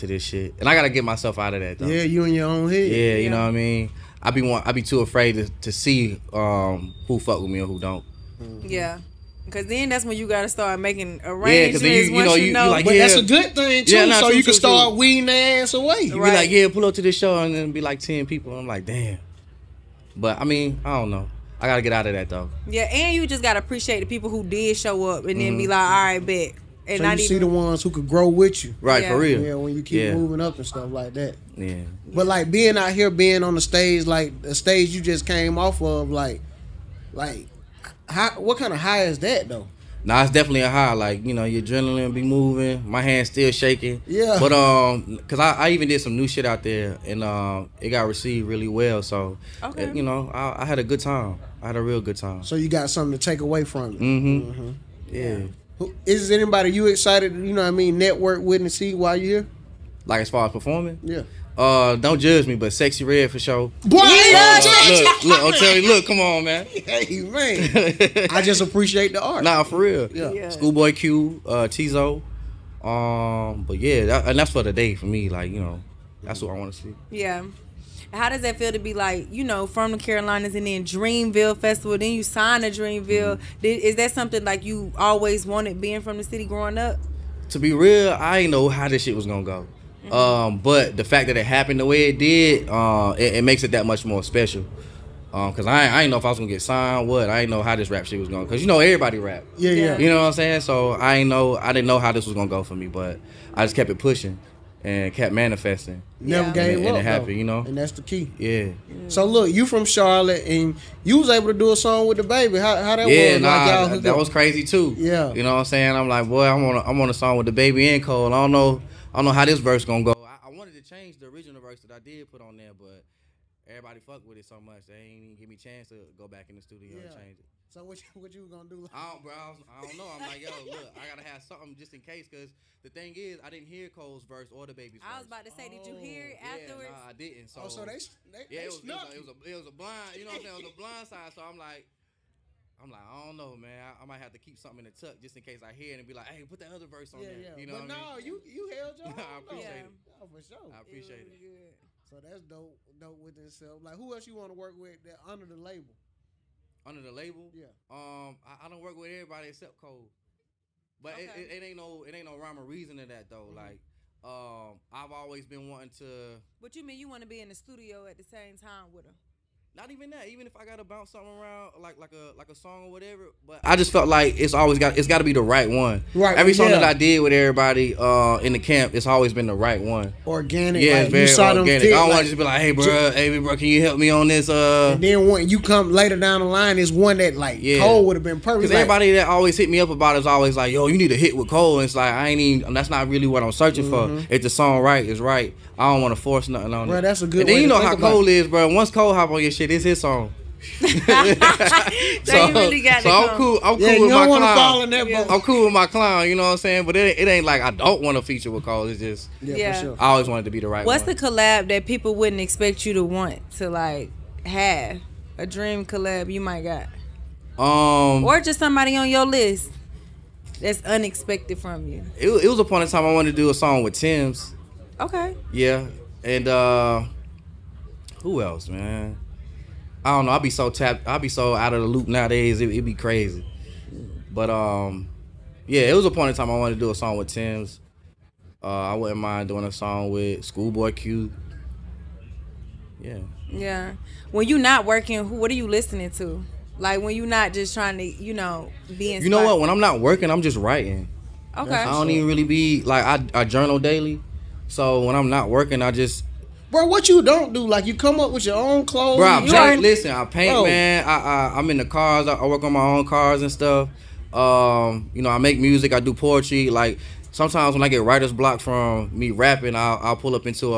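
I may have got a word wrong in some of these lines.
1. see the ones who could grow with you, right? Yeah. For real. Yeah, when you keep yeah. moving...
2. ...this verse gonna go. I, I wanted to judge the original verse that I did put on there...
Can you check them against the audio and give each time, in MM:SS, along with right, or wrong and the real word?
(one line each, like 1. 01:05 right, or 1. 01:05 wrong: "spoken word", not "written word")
1. 00:27 right
2. 01:59 wrong: "change", not "judge".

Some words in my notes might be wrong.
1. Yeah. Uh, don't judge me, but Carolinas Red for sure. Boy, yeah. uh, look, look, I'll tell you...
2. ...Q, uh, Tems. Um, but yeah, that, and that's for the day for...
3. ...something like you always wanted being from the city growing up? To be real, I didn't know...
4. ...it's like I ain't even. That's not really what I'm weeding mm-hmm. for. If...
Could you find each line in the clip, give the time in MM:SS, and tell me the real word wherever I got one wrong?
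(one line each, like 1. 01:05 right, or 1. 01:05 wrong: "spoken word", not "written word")
1. 01:01 wrong: "Sexyy", not "Carolinas"
2. 01:10 wrong: "Tizo", not "Tems"
3. 01:24 right
4. 03:11 wrong: "searching", not "weeding".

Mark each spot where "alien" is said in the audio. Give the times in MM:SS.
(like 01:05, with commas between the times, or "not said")
not said.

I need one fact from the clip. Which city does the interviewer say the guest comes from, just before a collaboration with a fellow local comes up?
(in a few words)
Charlotte.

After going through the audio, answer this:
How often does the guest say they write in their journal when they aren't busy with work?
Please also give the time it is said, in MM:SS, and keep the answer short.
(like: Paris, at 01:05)
Daily, at 04:13.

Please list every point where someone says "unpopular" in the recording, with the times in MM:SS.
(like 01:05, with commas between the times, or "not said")
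not said.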